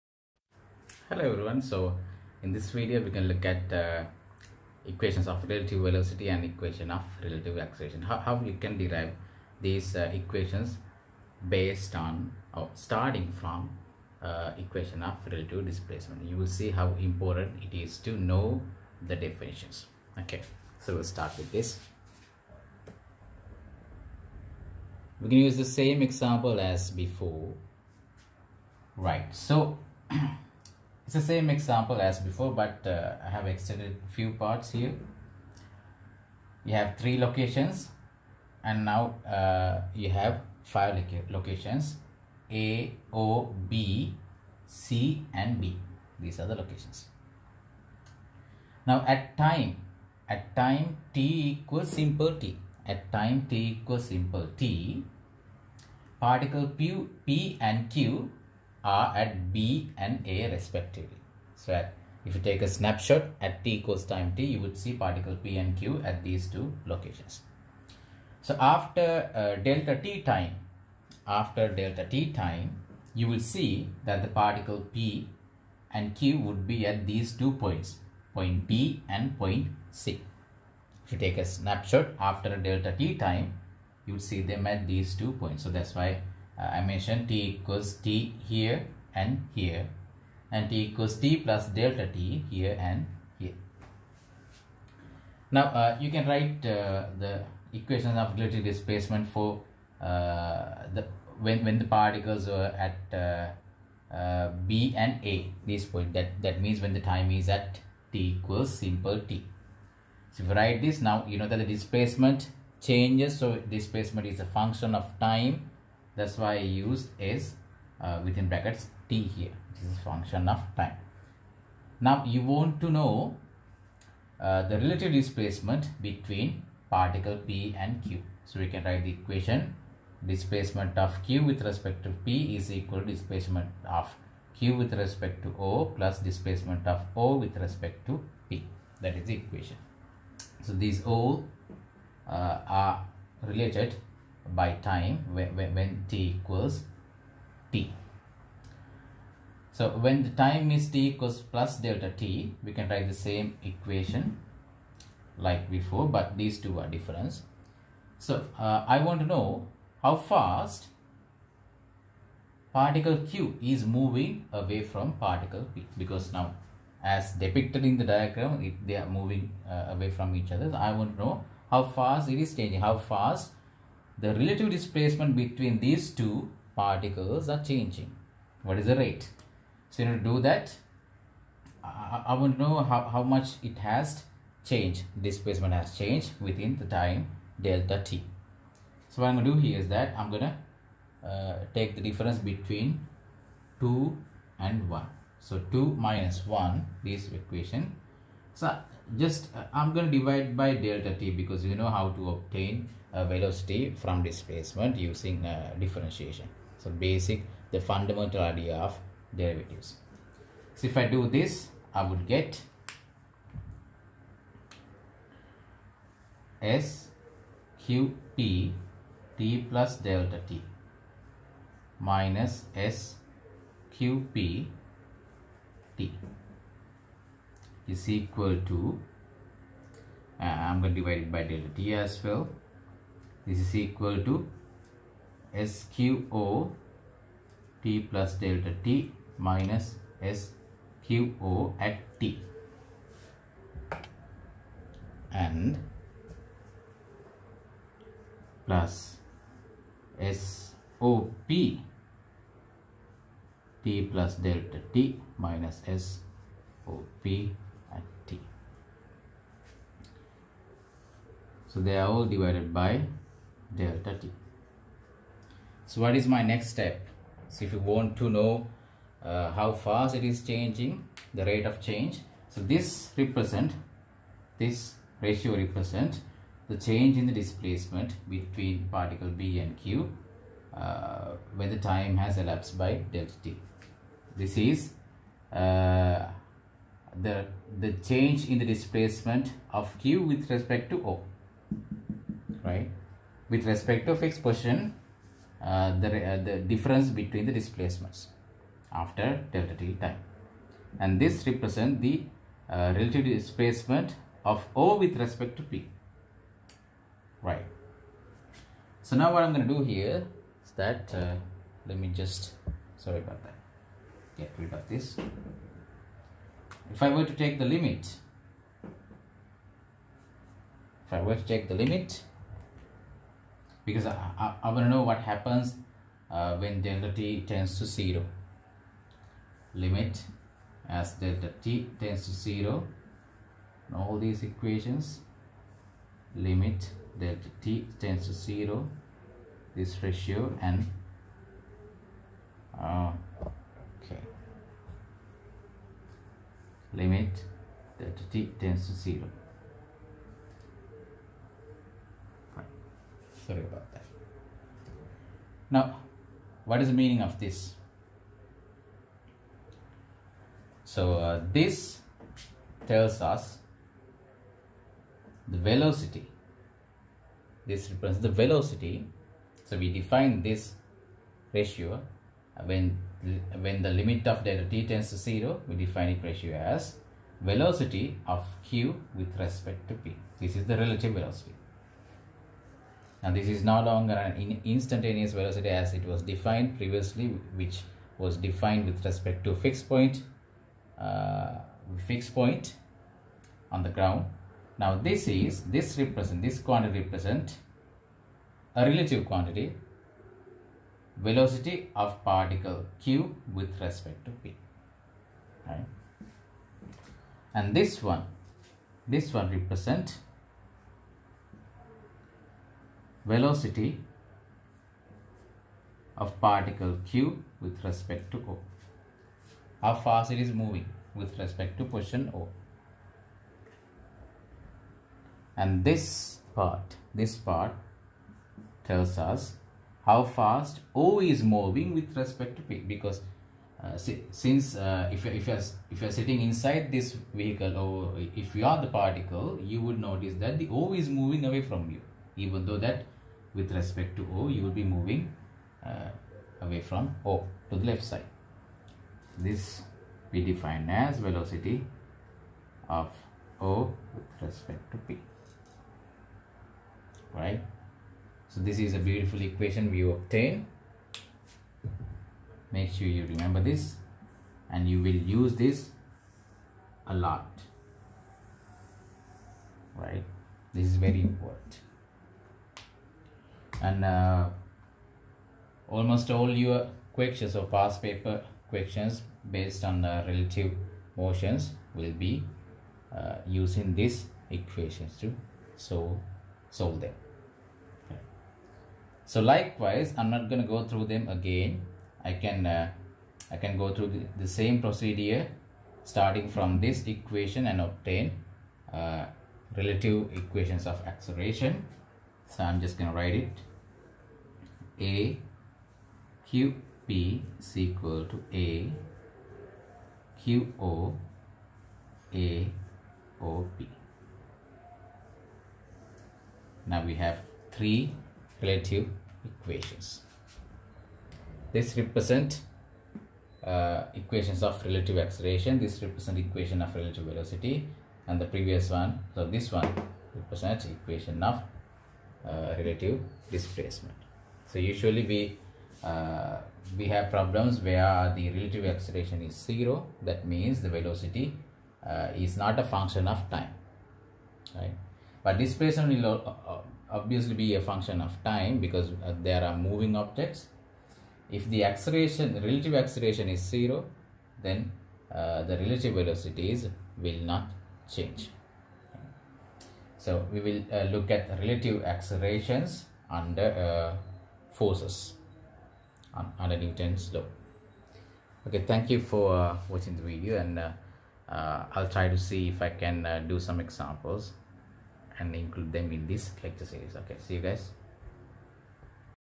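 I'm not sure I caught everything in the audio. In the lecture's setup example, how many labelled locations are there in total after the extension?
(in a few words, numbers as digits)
5.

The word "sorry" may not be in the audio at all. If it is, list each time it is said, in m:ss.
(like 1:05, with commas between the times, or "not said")
5:12, 5:53.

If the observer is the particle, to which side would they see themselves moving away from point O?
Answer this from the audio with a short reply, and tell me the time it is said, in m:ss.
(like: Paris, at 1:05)
left, at 7:27.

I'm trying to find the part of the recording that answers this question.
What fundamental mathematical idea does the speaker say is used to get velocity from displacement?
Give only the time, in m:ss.
3:29.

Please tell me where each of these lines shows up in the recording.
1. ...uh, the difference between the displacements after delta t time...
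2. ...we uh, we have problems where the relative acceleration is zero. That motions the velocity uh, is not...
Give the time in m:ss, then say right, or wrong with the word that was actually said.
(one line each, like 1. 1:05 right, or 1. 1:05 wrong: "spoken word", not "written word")
1. 4:56 right
2. 8:55 wrong: "means", not "motions".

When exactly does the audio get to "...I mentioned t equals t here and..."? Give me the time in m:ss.
1:26.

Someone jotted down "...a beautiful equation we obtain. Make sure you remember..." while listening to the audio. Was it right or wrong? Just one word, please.
right.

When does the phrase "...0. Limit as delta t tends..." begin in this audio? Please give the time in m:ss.
5:27.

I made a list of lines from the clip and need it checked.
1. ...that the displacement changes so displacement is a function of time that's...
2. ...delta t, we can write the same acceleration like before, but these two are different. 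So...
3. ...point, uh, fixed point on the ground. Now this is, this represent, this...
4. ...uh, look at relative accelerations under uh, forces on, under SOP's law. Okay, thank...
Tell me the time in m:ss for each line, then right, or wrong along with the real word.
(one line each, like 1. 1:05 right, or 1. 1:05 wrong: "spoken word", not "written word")
1. 1:51 right
2. 2:31 wrong: "equation", not "acceleration"
3. 6:29 right
4. 9:20 wrong: "Newton", not "SOP".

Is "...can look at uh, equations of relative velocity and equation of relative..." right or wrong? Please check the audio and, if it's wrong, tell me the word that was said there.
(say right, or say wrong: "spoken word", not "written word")
right.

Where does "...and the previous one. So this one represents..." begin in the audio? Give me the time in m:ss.
8:48.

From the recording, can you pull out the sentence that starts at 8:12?
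I can uh, I can go through the, the, same procedure starting from this equation and obtain uh, relative equations of acceleration.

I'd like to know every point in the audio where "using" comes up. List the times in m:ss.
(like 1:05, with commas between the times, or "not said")
3:24, 8:03.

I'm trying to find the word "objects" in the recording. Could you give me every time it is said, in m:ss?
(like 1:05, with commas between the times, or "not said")
9:10.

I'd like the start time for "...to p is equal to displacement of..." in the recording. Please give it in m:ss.
2:12.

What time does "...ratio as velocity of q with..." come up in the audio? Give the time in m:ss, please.
6:16.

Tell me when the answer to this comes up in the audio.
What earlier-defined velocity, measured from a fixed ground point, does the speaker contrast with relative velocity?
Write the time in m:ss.
6:24.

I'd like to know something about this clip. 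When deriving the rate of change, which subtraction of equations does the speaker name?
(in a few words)
2 minus 1.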